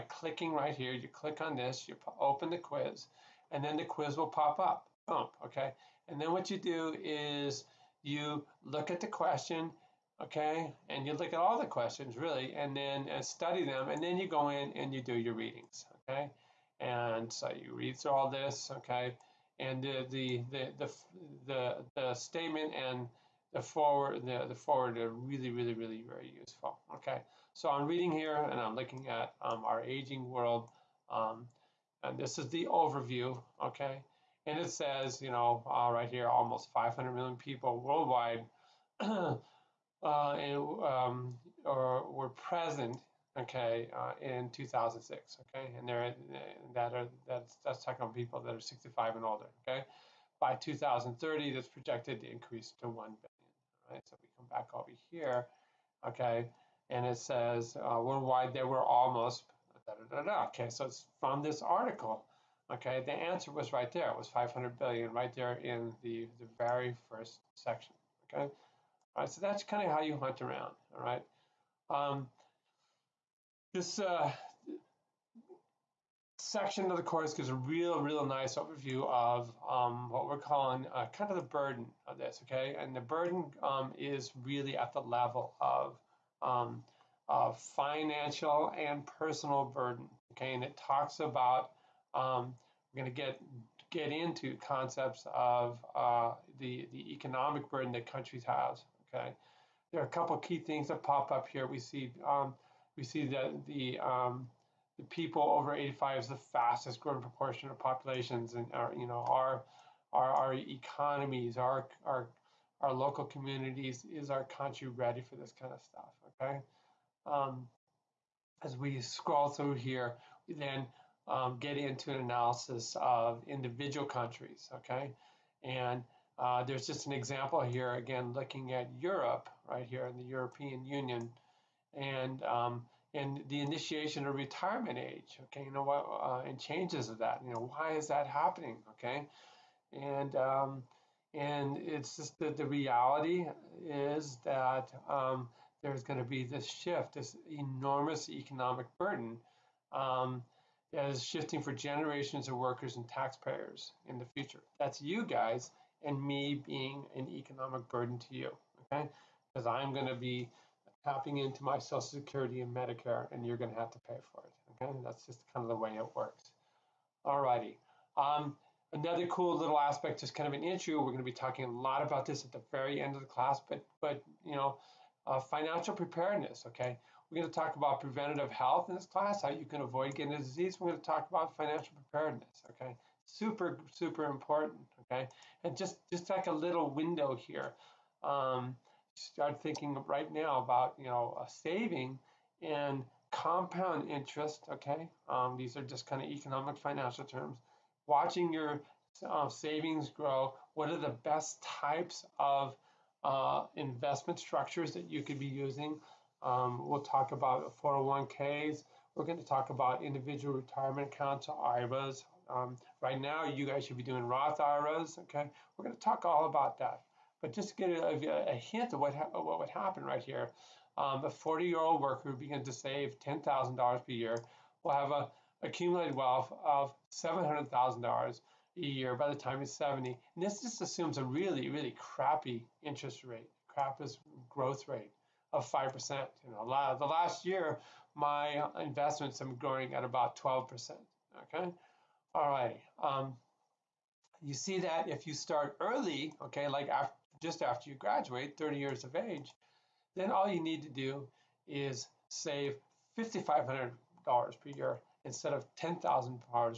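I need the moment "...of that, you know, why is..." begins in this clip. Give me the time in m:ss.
2:17.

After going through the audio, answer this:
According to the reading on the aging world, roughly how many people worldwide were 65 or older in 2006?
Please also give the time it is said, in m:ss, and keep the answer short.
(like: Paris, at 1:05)
almost 500 million, at 0:36.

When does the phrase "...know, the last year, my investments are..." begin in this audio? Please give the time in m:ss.
3:56.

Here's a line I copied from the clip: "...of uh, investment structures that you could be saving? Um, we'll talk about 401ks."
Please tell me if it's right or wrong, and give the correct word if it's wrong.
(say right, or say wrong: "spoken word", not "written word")
wrong: "using", not "saving".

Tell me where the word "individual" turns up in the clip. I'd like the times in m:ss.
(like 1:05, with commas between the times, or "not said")
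2:03, 3:30.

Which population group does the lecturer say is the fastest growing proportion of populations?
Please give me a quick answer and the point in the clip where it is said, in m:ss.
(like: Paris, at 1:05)
people over 85, at 1:45.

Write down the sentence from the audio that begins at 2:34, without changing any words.
That's you guys and me being an economic burden to you, okay?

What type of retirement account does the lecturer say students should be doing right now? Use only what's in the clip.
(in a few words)
Roth IRAs.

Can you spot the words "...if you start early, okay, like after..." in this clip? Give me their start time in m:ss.
4:05.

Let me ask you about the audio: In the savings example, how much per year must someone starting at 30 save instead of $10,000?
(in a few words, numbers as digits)
$5,500.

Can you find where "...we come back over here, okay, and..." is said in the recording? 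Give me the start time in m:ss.
0:54.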